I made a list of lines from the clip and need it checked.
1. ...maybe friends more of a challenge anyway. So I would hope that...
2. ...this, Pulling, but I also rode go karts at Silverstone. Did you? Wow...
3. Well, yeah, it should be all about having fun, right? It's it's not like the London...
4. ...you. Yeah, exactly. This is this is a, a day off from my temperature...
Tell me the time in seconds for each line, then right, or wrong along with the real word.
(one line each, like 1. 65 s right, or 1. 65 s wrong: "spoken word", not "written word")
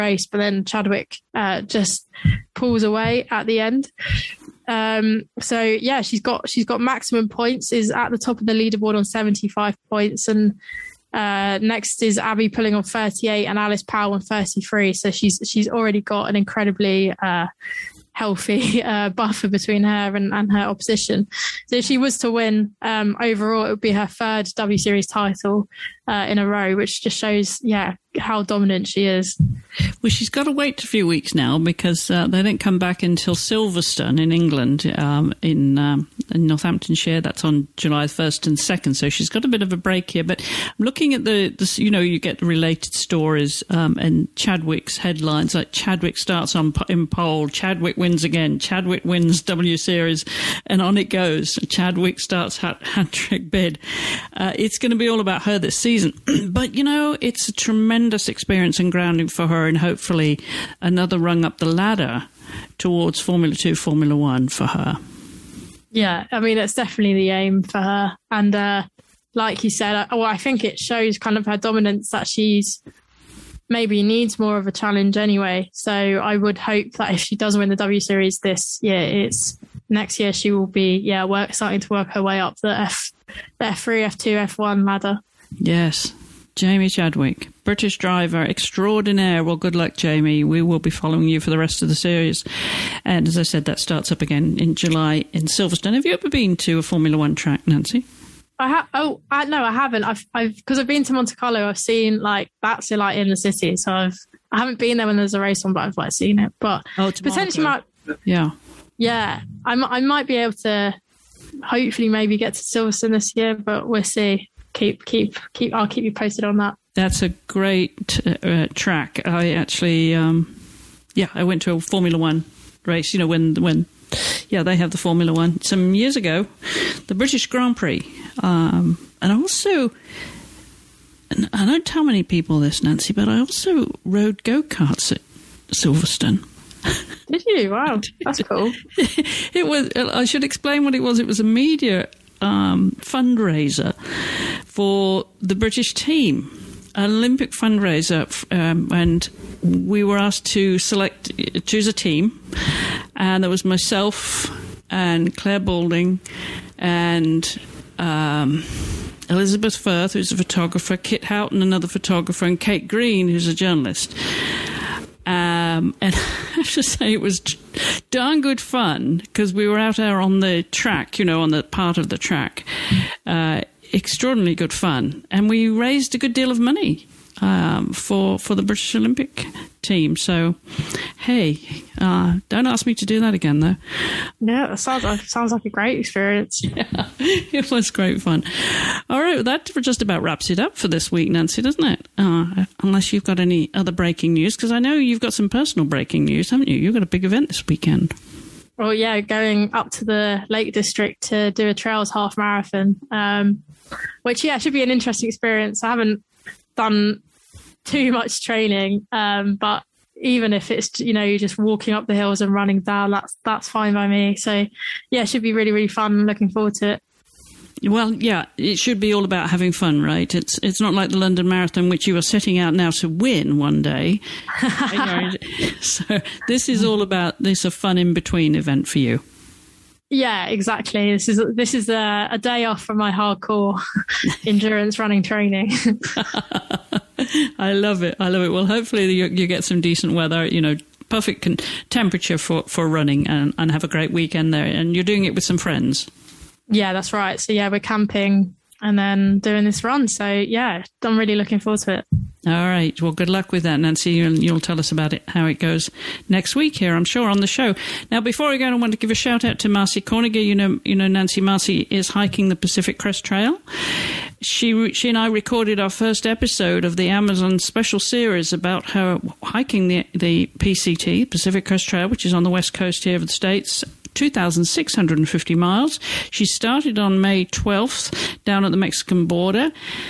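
1. 73 s wrong: "needs", not "friends"
2. 132 s wrong: "Nancy", not "Pulling"
3. 217 s right
4. 228 s wrong: "hardcore", not "temperature".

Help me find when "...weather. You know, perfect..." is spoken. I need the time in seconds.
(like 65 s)
240 s.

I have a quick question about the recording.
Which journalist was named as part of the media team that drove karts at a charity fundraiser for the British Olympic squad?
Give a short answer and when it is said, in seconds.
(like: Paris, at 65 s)
Kate Green, at 162 s.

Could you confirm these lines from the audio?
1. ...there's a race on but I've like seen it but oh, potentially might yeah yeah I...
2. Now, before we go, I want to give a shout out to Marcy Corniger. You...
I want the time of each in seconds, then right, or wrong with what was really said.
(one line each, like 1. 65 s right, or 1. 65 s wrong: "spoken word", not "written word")
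1. 105 s right
2. 258 s right.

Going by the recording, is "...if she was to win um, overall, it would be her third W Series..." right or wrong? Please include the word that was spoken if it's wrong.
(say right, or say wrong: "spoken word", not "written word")
right.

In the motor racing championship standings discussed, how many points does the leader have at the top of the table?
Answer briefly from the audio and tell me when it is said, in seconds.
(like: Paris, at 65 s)
75, at 9 s.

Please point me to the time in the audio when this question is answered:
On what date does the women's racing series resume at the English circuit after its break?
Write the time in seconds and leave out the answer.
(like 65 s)
37 s.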